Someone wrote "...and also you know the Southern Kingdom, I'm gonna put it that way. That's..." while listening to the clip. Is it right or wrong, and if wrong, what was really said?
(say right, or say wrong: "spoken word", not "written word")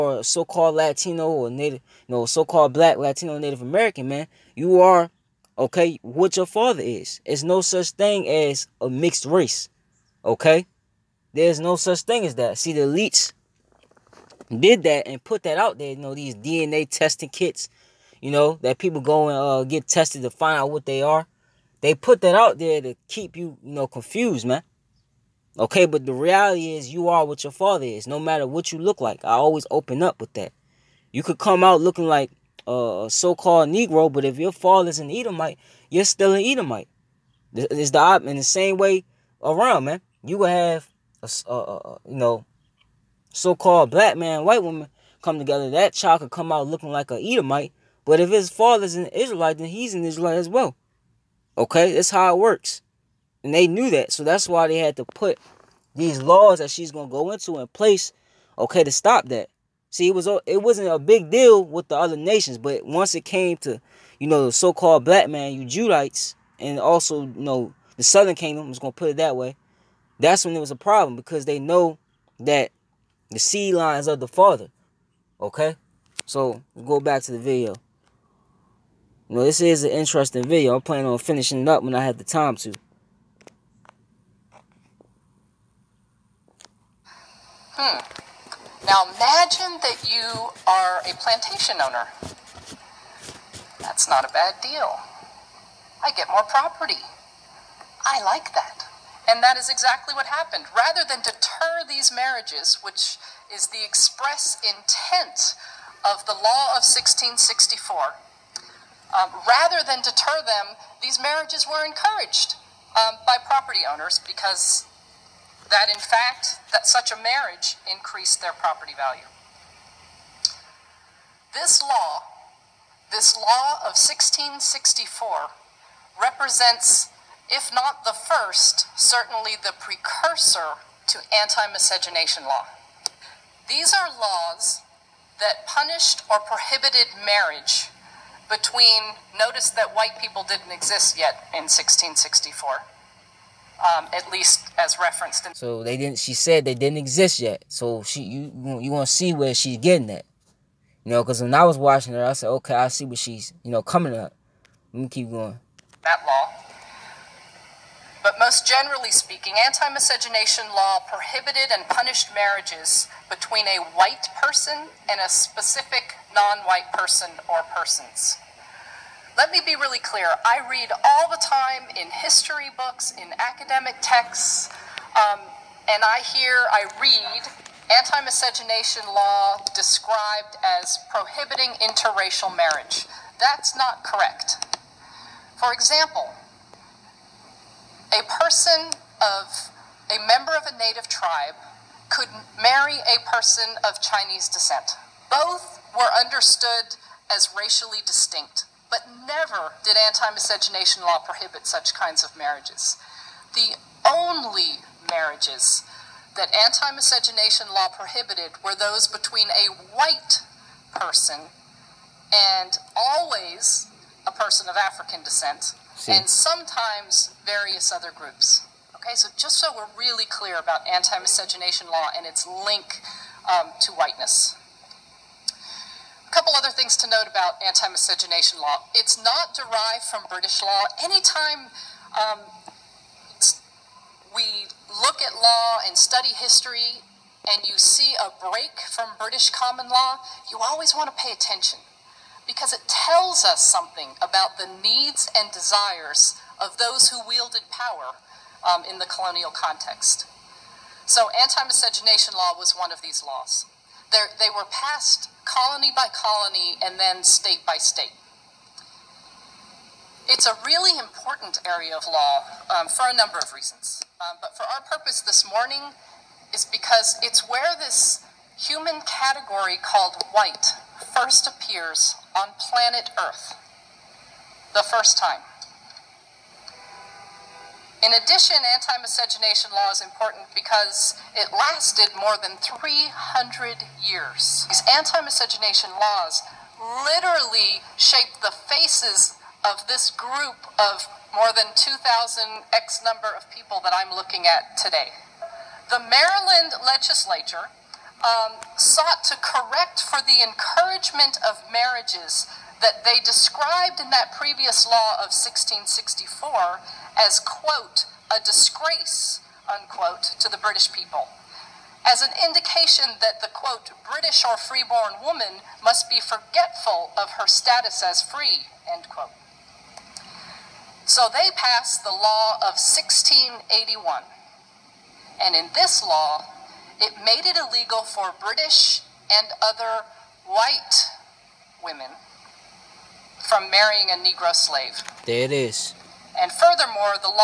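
right.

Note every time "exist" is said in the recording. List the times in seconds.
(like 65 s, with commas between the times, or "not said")
140 s, 146 s.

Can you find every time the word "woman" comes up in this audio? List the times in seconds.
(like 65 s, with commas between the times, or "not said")
44 s, 315 s.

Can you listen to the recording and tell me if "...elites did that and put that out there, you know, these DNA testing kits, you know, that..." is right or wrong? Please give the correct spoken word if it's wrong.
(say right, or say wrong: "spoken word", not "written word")
right.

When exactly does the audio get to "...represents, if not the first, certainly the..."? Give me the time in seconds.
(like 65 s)
126 s.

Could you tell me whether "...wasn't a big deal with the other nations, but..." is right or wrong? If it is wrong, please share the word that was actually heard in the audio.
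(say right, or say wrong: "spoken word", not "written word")
right.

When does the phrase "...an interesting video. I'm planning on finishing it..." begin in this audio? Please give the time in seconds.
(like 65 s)
79 s.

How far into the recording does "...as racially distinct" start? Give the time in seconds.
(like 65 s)
197 s.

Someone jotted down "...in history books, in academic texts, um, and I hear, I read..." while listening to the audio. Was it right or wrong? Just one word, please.
right.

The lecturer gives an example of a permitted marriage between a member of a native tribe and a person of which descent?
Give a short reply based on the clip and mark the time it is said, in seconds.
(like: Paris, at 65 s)
Chinese, at 194 s.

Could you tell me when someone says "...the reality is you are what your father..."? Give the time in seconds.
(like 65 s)
26 s.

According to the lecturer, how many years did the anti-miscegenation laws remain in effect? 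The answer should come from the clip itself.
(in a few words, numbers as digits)
more than 300 years.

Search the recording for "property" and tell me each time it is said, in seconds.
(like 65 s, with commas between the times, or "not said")
96 s, 113 s, 118 s.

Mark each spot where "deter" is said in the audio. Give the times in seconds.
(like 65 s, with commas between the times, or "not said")
101 s, 110 s.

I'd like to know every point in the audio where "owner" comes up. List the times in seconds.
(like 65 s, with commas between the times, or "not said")
91 s, 113 s.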